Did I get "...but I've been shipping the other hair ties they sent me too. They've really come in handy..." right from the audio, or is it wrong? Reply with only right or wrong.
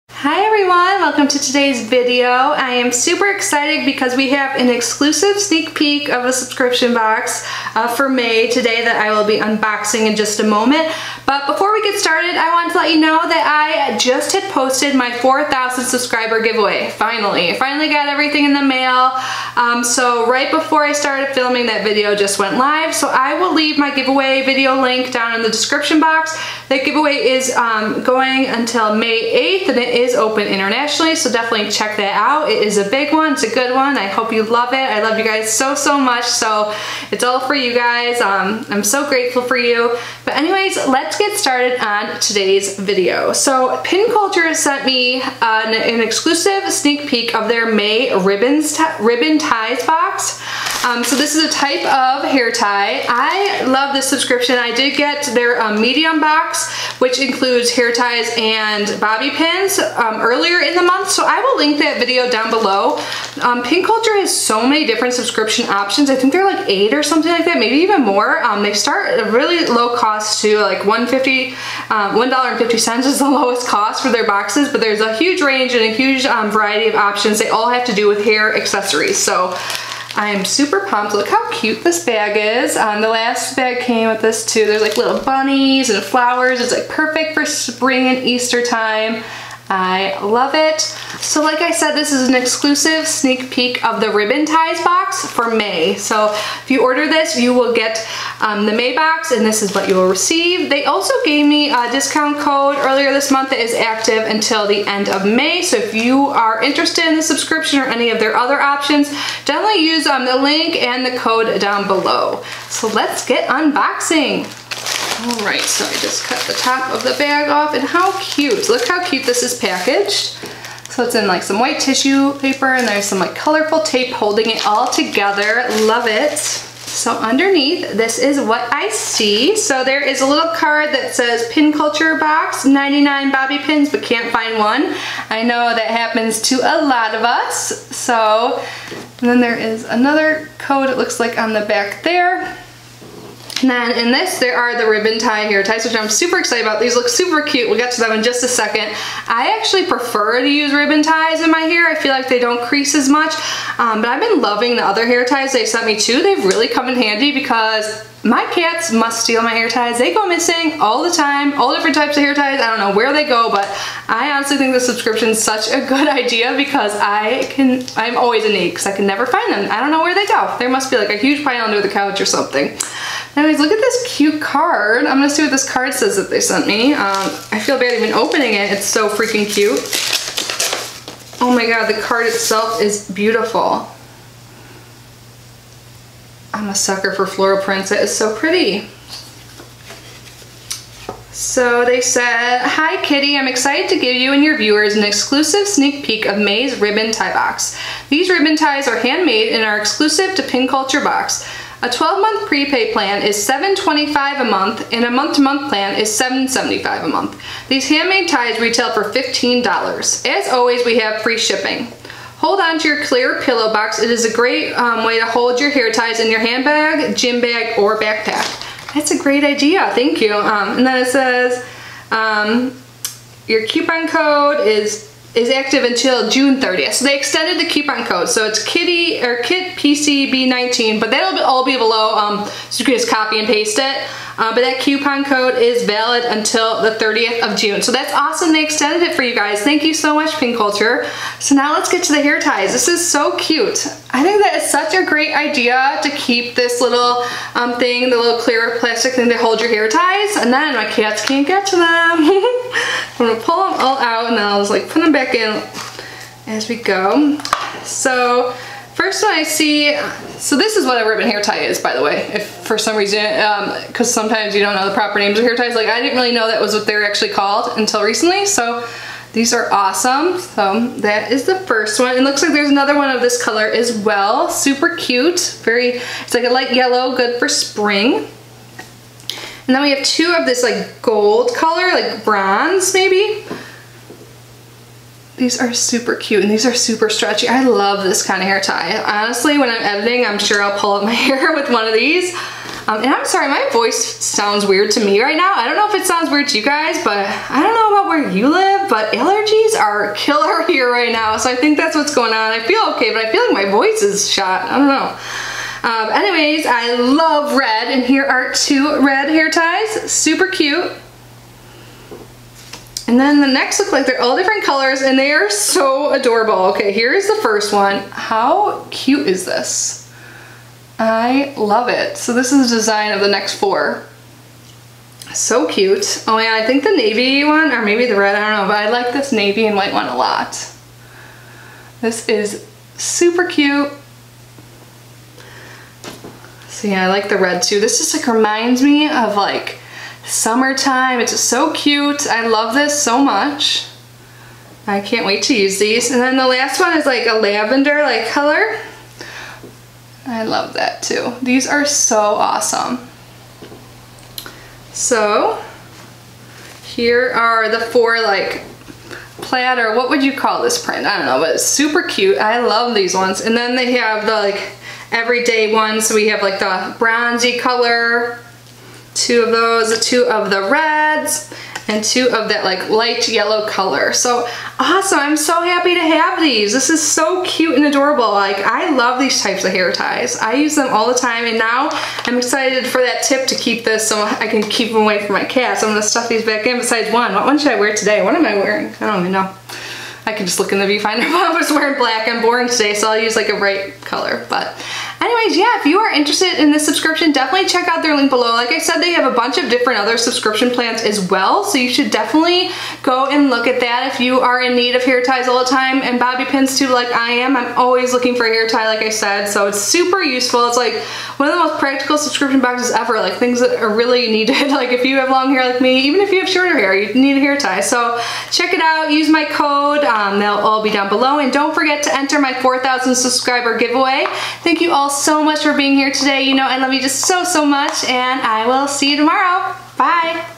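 wrong.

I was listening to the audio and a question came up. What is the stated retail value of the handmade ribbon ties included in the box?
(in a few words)
$15.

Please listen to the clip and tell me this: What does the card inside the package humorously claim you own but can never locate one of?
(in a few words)
99 bobby pins.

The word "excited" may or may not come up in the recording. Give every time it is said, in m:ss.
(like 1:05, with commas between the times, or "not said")
0:03, 2:26, 3:13, 6:22.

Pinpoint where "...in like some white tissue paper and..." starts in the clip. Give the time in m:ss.
2:01.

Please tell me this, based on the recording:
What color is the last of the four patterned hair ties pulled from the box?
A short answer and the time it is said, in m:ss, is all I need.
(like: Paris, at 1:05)
lavender, at 5:47.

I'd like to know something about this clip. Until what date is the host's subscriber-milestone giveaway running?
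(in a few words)
May 8th.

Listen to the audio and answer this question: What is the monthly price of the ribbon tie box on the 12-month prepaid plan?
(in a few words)
$7.25.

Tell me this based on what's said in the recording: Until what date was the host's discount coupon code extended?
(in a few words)
June 30th.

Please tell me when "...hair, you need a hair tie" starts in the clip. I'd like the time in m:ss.
6:56.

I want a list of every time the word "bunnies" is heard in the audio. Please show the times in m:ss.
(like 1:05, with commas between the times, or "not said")
1:25.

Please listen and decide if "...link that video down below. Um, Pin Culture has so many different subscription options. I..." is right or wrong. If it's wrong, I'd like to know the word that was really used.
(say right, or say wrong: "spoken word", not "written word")
right.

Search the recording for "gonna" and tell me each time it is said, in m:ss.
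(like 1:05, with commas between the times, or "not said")
2:55, 6:25.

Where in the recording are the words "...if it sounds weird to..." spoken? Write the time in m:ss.
4:55.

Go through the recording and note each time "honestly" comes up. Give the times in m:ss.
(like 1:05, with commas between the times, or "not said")
2:44, 4:49.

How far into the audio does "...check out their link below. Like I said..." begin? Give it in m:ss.
6:37.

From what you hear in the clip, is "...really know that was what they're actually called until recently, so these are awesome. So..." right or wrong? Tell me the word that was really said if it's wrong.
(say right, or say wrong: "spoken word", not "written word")
right.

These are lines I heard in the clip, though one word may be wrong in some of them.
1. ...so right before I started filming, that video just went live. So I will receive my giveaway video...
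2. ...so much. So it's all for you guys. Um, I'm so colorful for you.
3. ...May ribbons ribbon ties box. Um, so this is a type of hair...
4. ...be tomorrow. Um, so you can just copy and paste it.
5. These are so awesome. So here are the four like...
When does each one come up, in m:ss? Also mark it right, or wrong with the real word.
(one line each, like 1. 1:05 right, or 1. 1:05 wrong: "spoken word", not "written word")
1. 0:19 wrong: "leave", not "receive"
2. 0:35 wrong: "grateful", not "colorful"
3. 0:47 right
4. 3:51 wrong: "below", not "tomorrow"
5. 5:51 right.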